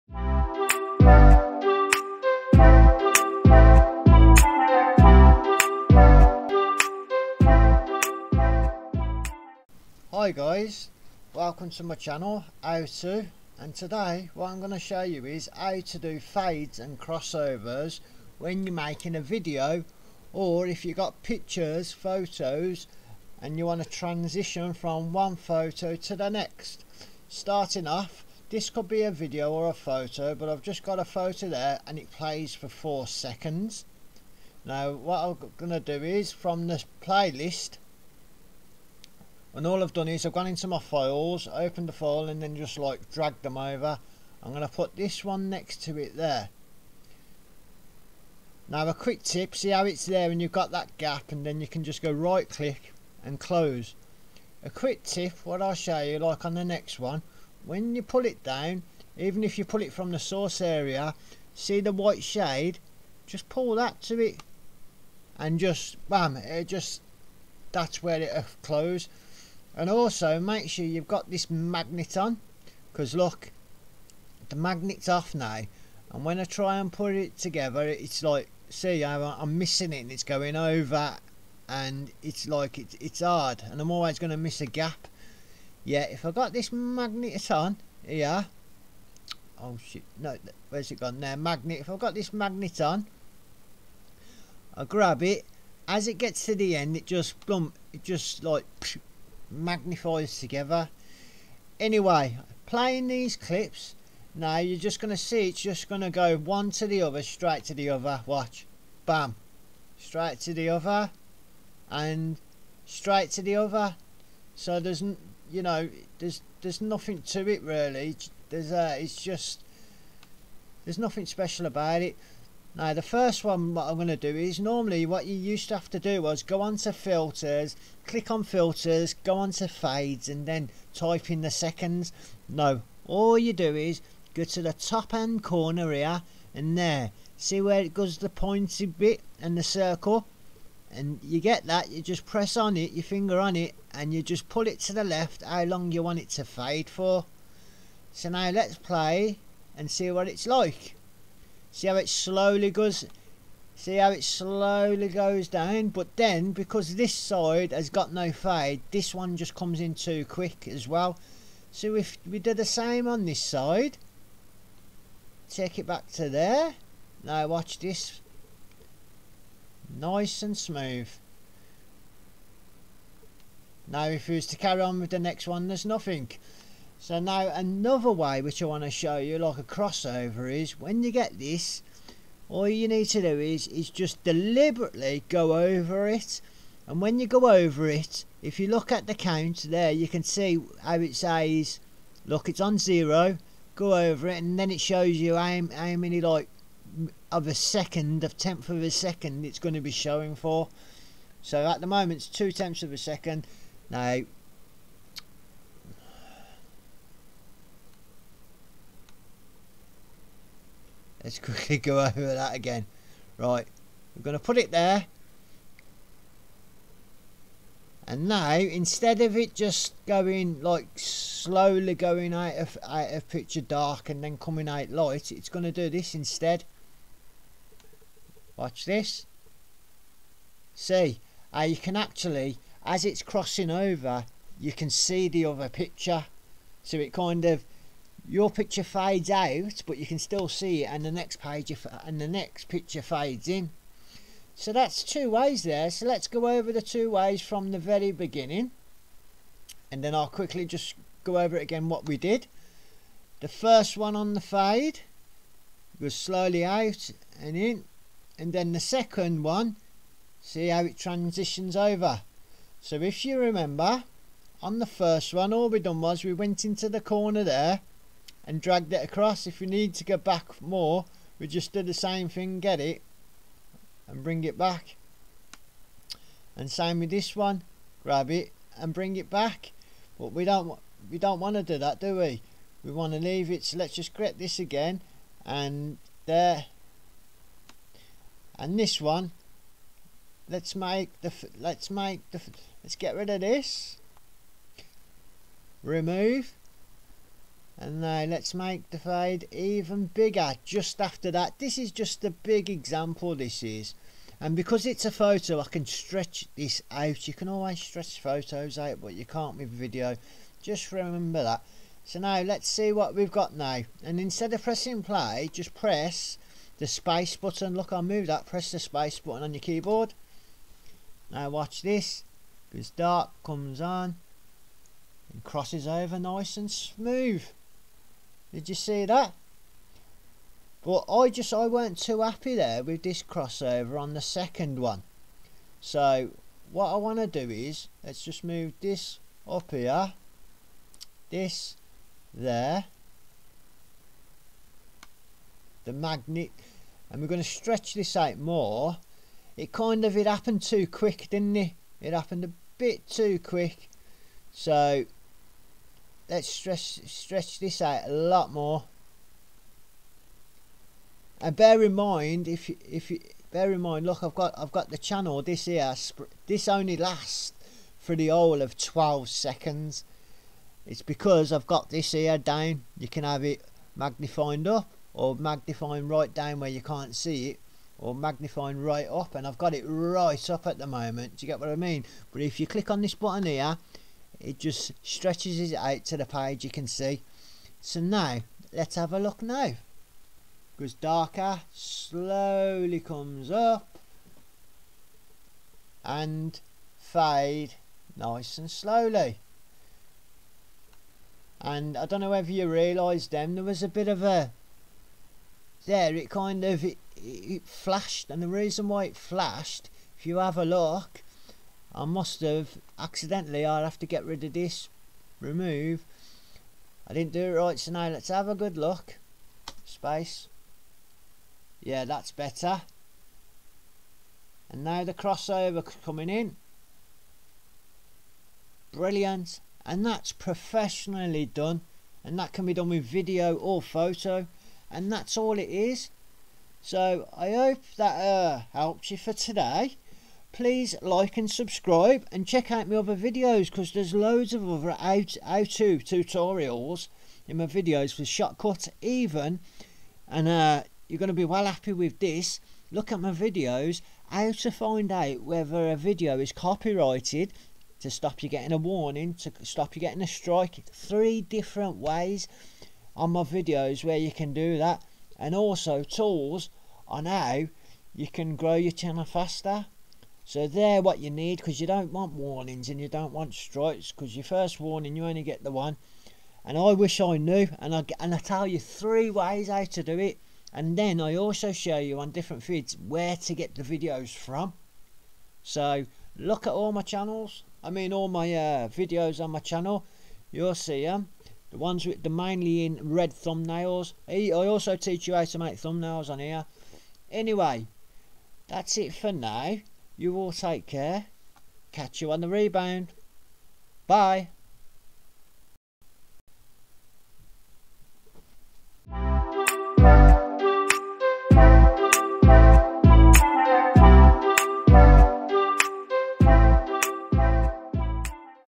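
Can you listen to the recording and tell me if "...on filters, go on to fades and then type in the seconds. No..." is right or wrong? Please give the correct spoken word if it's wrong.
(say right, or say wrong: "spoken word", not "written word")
right.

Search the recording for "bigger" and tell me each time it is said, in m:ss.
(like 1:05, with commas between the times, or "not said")
5:00.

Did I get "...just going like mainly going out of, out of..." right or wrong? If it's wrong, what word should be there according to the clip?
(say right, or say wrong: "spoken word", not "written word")
wrong: "slowly", not "mainly".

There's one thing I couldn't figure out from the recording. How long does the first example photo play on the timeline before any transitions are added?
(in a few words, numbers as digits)
4 seconds.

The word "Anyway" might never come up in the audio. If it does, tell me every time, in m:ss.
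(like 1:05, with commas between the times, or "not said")
1:41, 8:17.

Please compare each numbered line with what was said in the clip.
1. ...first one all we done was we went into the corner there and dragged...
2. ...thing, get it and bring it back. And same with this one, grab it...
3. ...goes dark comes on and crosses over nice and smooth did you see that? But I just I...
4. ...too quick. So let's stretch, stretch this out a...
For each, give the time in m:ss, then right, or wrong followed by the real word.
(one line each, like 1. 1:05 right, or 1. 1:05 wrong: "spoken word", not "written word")
1. 4:24 right
2. 4:32 right
3. 5:22 right
4. 5:53 right.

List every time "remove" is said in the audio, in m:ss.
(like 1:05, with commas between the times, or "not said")
4:55, 6:55.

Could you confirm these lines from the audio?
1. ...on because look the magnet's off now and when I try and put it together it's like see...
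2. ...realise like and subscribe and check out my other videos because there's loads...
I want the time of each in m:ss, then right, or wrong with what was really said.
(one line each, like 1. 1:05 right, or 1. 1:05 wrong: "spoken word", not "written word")
1. 1:12 right
2. 7:20 wrong: "please", not "realise".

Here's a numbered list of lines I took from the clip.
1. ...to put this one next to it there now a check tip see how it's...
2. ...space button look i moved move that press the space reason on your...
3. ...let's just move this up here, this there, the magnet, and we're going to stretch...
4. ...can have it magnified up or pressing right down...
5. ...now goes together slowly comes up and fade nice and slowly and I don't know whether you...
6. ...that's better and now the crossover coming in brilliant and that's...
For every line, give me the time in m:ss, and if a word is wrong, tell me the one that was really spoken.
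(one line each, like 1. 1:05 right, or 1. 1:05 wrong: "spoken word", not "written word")
1. 0:44 wrong: "quick", not "check"
2. 5:16 wrong: "button", not "reason"
3. 5:38 right
4. 6:13 wrong: "magnifying", not "pressing"
5. 6:29 wrong: "darker", not "together"
6. 7:02 right.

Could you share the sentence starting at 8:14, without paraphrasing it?
I also teach you how to make thumbnails on here.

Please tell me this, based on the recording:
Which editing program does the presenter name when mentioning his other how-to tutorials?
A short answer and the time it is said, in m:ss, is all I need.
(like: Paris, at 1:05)
Shotcut, at 7:28.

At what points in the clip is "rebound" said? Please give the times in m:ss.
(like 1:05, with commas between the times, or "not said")
8:22.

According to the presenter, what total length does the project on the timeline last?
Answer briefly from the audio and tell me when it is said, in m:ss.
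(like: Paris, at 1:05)
12 seconds, at 6:08.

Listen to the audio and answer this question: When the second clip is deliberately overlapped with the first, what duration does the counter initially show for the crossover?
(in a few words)
two tenths of a second.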